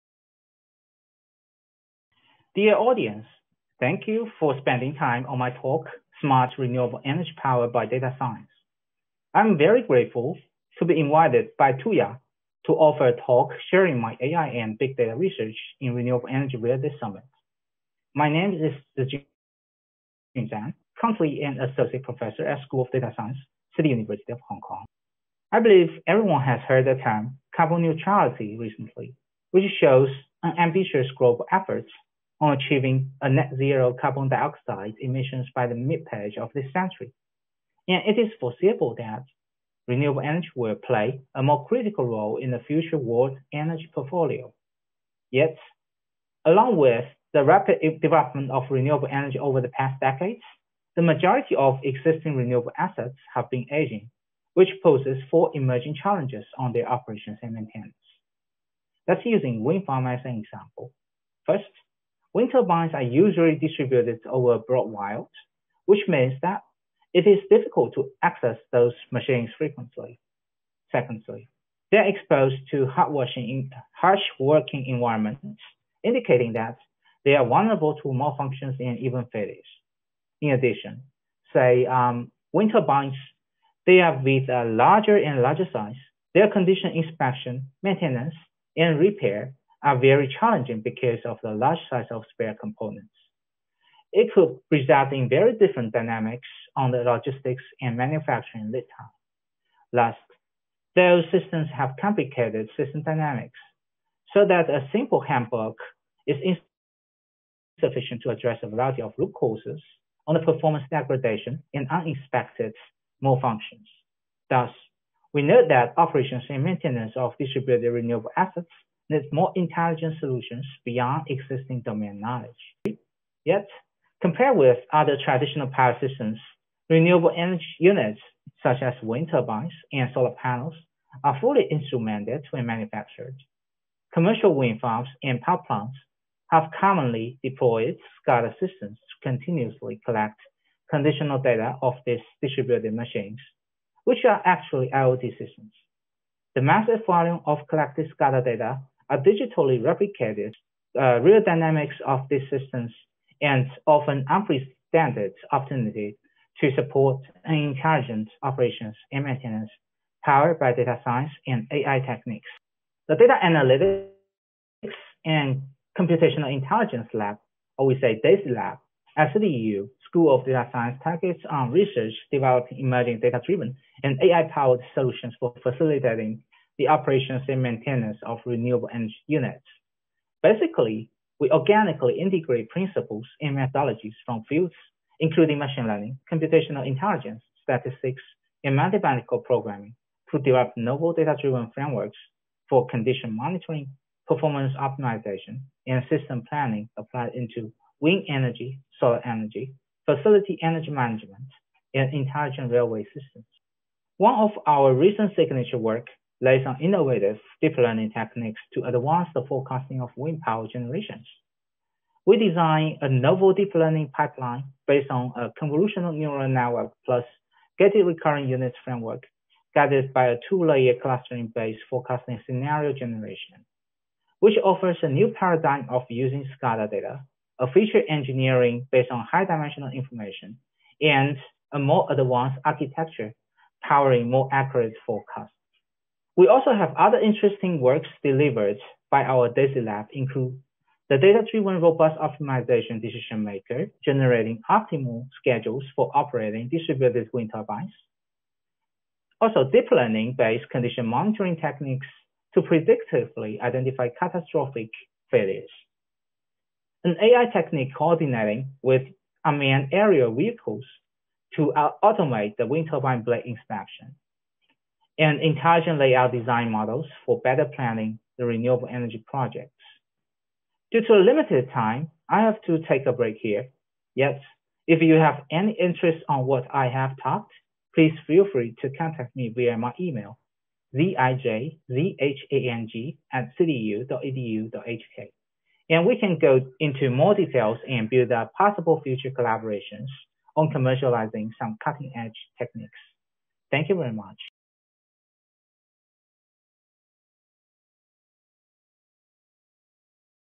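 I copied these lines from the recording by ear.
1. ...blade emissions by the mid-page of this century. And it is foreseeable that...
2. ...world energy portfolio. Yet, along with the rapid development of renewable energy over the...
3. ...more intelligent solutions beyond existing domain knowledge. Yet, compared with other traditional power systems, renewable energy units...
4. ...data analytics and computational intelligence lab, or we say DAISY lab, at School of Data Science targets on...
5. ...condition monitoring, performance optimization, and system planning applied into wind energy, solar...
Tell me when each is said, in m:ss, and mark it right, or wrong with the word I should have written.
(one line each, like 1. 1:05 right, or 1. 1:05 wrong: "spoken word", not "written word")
1. 0:34 wrong: "dioxide", not "blade"
2. 0:42 right
3. 1:59 right
4. 2:43 right
5. 3:12 right.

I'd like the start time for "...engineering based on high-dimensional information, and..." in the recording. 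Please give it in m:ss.
3:48.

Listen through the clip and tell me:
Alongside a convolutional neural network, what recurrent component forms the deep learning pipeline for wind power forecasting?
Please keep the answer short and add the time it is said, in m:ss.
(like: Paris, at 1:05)
gated recurrent units, at 3:37.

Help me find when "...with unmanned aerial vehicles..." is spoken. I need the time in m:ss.
4:18.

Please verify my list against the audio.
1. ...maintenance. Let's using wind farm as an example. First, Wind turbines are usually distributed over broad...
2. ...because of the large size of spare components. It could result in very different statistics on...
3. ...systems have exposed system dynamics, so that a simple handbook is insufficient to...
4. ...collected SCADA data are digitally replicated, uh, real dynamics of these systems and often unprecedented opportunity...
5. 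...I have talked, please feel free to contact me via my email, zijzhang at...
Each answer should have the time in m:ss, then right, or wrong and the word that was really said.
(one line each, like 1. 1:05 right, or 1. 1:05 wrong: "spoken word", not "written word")
1. 0:57 right
2. 1:30 wrong: "dynamics", not "statistics"
3. 1:41 wrong: "complicated", not "exposed"
4. 2:27 right
5. 4:36 right.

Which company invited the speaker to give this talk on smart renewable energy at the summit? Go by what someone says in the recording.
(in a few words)
Tuya.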